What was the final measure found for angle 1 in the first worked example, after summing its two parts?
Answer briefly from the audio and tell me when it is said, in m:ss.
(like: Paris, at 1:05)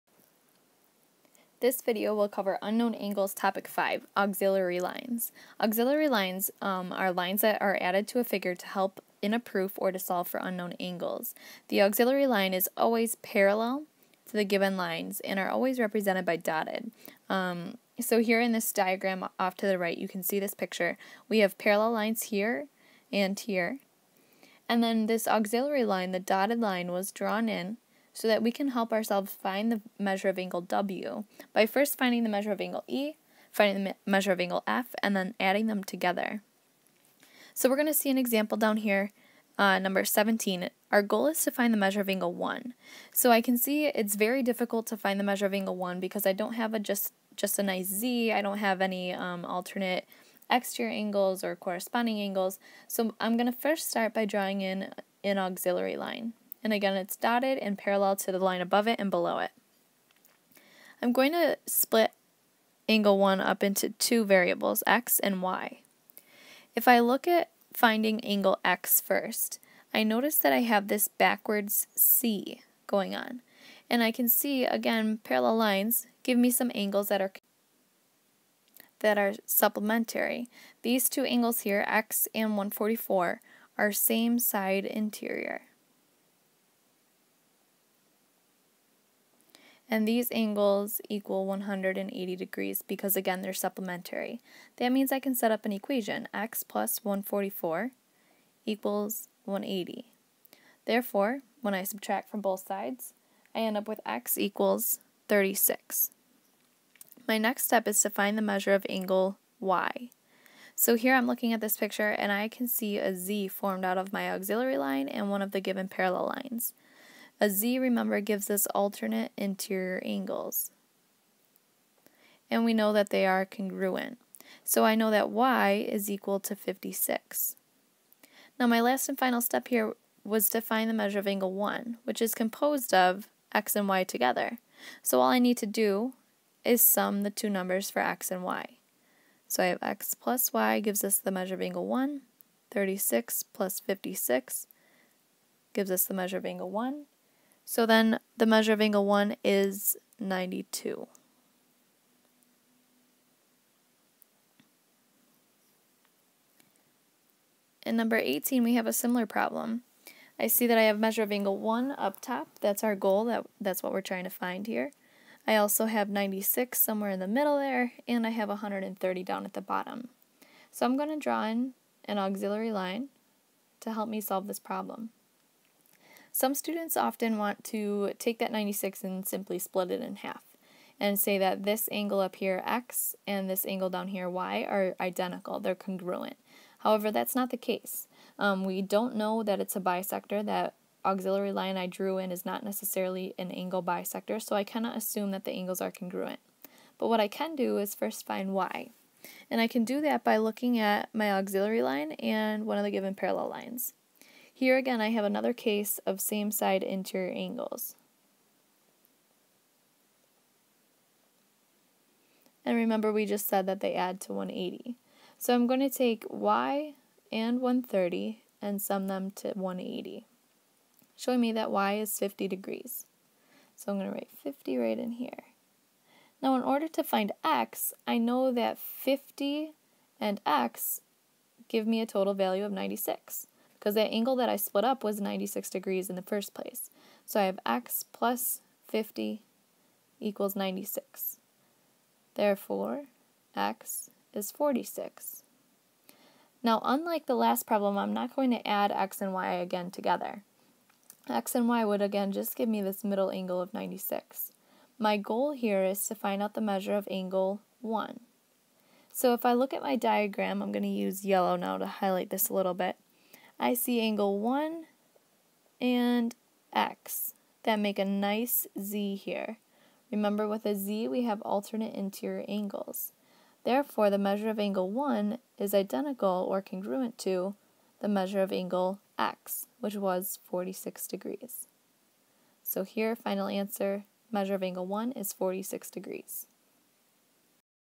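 92, at 2:30.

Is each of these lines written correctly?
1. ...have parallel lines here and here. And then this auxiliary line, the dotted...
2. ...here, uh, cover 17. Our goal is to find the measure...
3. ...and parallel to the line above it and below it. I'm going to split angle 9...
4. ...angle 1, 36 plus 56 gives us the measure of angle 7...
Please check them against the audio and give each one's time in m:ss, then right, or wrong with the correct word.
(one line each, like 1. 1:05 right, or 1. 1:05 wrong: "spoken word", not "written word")
1. 0:21 right
2. 0:38 wrong: "number", not "cover"
3. 0:57 wrong: "1", not "9"
4. 2:21 wrong: "1", not "7".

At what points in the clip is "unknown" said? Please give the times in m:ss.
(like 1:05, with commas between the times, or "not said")
0:02, 0:10.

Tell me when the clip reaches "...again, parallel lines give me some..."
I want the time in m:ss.
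1:14.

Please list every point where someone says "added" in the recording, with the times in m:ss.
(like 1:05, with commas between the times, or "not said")
0:07.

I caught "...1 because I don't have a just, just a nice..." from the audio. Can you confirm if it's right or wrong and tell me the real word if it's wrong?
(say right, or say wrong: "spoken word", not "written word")
right.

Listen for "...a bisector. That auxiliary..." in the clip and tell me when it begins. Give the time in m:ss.
3:09.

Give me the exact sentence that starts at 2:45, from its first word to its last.
I also have 96 somewhere in the middle there, and I have 130 down at the bottom.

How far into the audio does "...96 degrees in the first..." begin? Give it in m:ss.
3:55.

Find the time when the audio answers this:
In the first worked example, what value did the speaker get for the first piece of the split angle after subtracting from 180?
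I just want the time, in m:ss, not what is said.
1:44.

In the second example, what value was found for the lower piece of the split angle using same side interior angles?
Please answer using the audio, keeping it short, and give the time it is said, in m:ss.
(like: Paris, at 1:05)
50 degrees, at 3:41.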